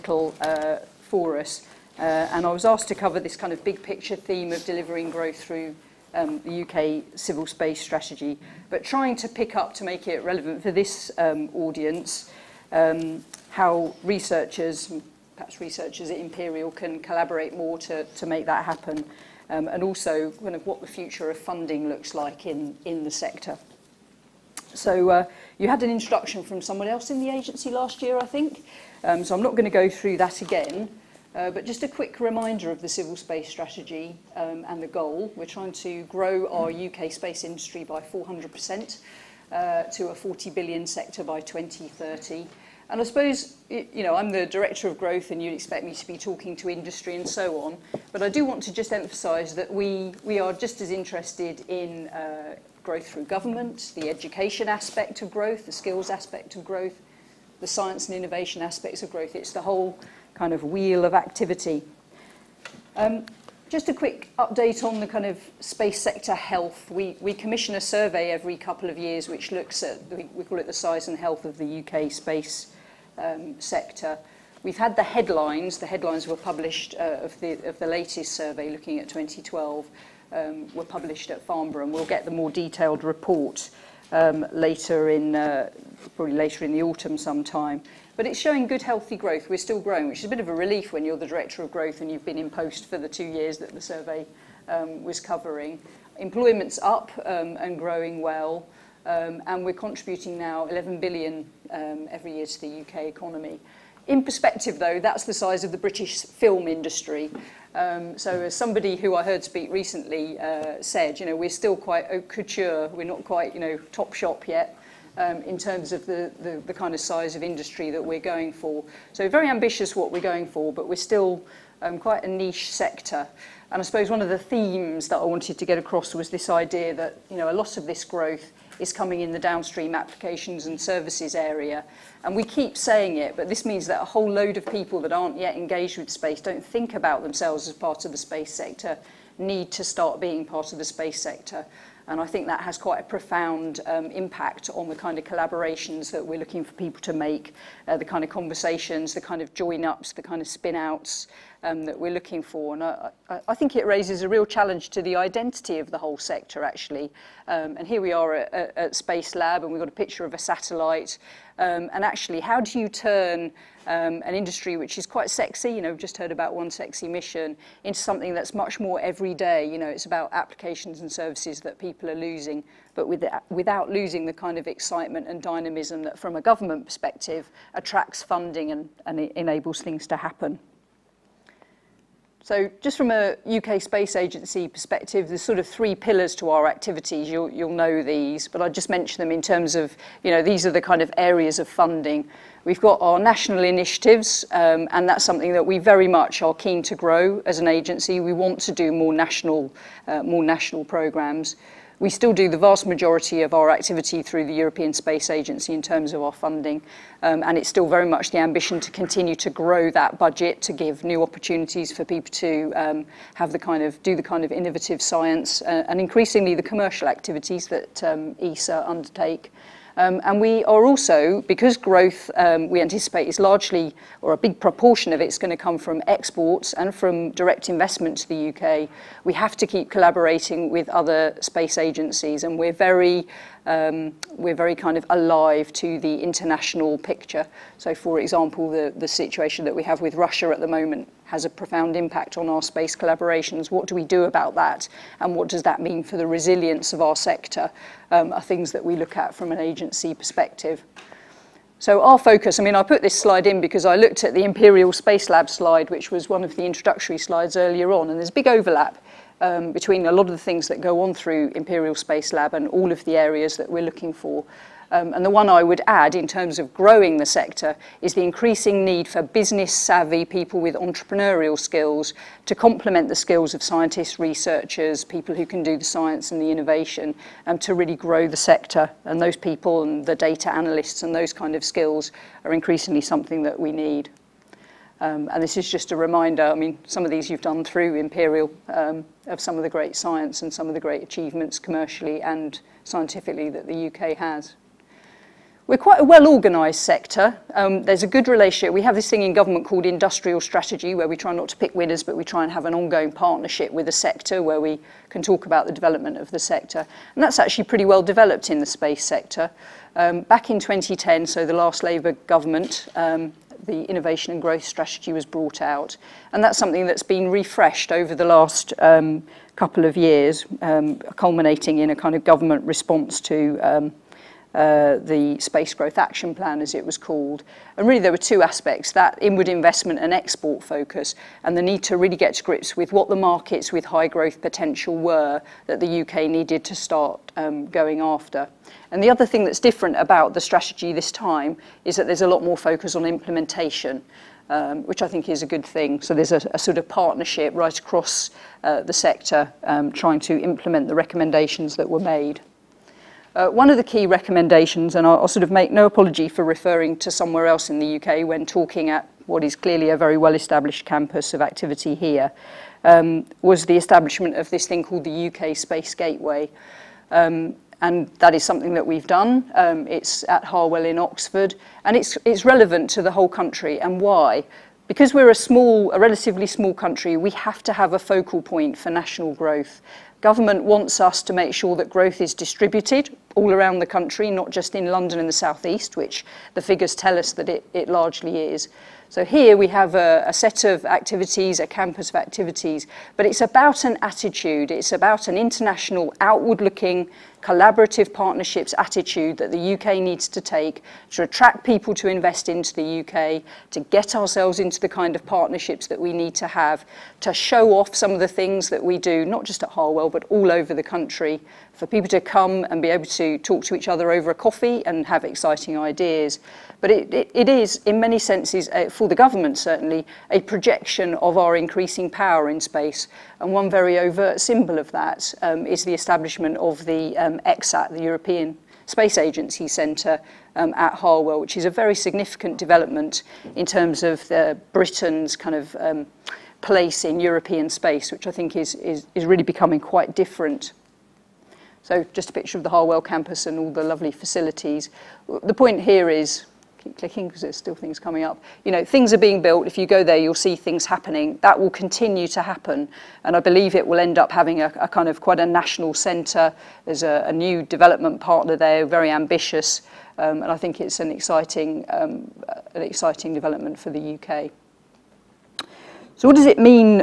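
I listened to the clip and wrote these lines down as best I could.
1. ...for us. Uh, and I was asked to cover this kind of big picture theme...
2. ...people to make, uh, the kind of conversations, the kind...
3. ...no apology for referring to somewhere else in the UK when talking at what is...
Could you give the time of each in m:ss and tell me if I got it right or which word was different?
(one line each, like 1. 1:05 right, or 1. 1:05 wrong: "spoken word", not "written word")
1. 0:01 right
2. 2:26 right
3. 5:55 right.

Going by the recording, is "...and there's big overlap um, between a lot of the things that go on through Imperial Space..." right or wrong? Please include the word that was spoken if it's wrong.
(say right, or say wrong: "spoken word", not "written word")
right.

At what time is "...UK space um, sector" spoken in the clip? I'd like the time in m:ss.
1:11.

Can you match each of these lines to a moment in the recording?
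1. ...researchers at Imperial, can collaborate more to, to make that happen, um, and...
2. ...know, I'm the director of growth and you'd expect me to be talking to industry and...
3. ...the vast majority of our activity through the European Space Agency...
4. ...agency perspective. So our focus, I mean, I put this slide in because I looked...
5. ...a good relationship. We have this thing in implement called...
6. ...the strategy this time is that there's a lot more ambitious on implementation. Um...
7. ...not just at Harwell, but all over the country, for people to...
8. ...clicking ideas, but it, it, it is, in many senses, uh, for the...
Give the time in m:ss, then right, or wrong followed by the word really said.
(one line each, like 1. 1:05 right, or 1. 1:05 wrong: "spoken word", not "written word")
1. 0:15 right
2. 0:44 right
3. 3:22 right
4. 4:09 right
5. 4:58 wrong: "government", not "implement"
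6. 5:40 wrong: "focus", not "ambitious"
7. 6:49 right
8. 6:55 wrong: "exciting", not "clicking".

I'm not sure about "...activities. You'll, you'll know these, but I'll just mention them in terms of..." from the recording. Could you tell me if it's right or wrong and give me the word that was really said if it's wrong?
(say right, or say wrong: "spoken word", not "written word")
right.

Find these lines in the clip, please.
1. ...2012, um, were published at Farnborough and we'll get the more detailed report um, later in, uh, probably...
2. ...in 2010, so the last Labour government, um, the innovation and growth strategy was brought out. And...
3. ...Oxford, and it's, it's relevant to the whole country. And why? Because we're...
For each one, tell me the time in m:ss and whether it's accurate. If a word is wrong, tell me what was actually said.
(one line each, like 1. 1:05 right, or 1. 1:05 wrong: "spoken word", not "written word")
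1. 1:19 right
2. 5:10 right
3. 6:10 right.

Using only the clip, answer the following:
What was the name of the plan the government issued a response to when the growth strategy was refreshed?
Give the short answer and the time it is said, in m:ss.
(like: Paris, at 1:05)
Space Growth Action Plan, at 5:25.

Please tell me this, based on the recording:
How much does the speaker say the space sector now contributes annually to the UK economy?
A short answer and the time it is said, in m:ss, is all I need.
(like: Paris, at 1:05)
11 billion, at 1:40.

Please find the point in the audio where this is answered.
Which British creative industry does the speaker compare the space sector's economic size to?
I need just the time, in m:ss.
1:45.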